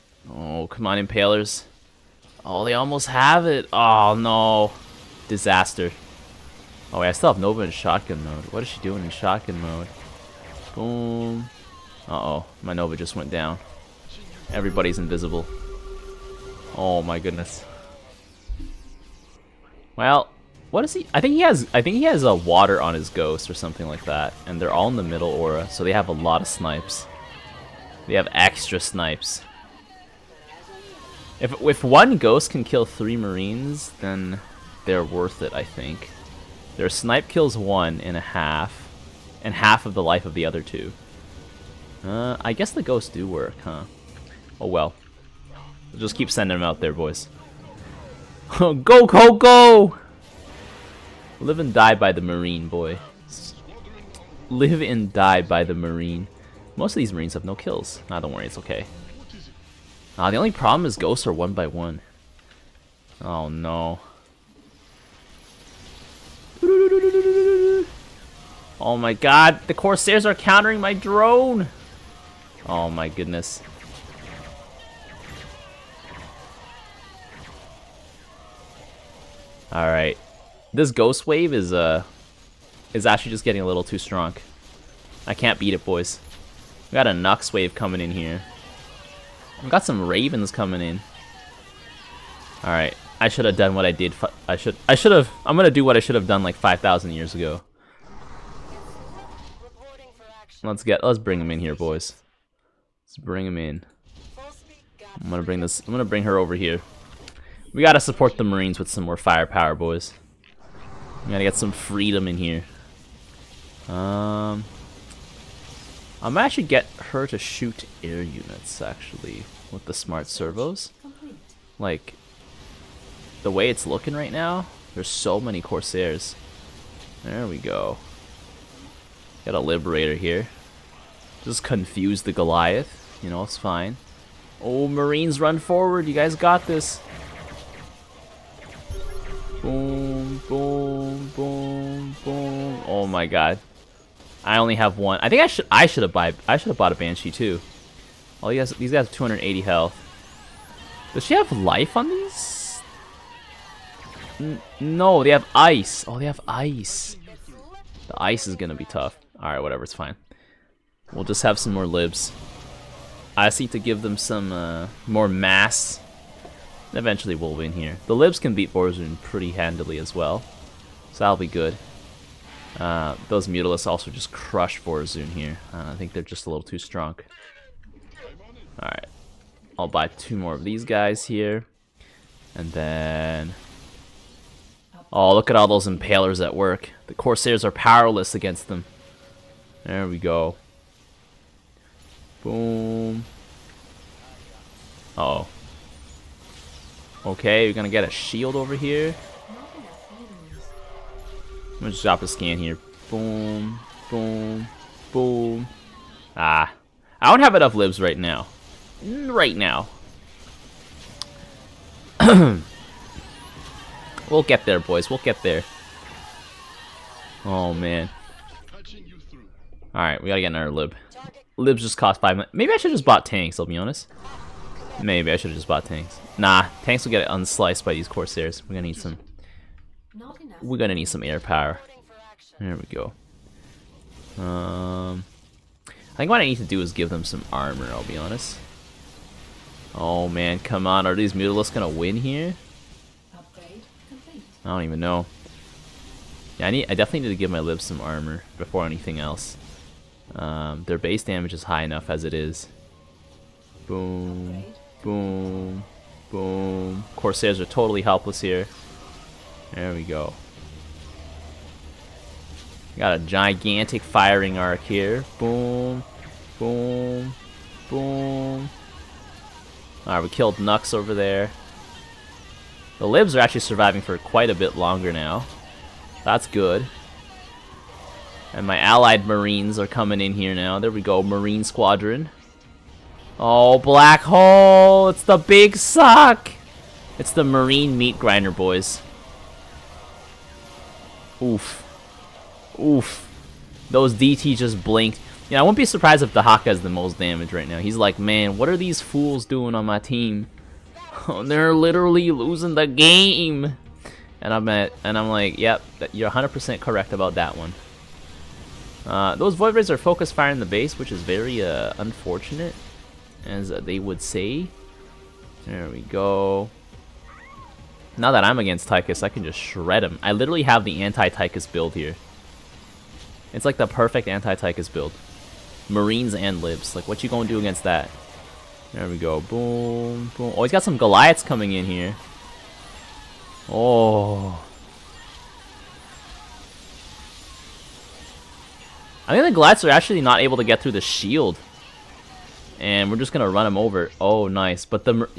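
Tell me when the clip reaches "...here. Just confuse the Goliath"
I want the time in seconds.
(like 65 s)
130 s.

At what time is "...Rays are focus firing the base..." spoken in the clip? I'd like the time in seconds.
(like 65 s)
309 s.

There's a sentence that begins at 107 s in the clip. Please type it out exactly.
We gotta support the Marines with some more firepower, boys.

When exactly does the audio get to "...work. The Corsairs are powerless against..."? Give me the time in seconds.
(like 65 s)
186 s.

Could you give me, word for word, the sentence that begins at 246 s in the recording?
I definitely need to give my libs some armor before anything else.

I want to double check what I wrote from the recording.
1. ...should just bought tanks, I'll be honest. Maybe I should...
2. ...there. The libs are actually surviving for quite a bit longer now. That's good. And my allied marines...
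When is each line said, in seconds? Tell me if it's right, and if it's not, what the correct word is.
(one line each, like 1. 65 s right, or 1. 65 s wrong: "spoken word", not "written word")
1. 222 s right
2. 271 s right.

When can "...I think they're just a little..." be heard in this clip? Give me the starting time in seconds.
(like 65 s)
175 s.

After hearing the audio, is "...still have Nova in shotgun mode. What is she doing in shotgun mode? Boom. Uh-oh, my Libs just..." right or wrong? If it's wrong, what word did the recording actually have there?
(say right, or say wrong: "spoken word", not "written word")
wrong: "Nova", not "Libs".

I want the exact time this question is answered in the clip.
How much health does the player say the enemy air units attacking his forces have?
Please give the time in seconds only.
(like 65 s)
149 s.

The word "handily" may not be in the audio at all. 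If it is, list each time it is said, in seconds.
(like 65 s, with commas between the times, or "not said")
169 s.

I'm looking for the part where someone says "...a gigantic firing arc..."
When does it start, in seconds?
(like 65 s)
263 s.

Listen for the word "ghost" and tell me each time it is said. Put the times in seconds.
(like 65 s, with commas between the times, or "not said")
23 s, 32 s, 42 s, 60 s, 80 s.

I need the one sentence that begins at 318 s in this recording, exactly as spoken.
Now that I'm against Tychus, I can just shred him.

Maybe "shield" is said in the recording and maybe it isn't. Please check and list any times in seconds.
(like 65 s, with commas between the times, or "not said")
198 s, 340 s.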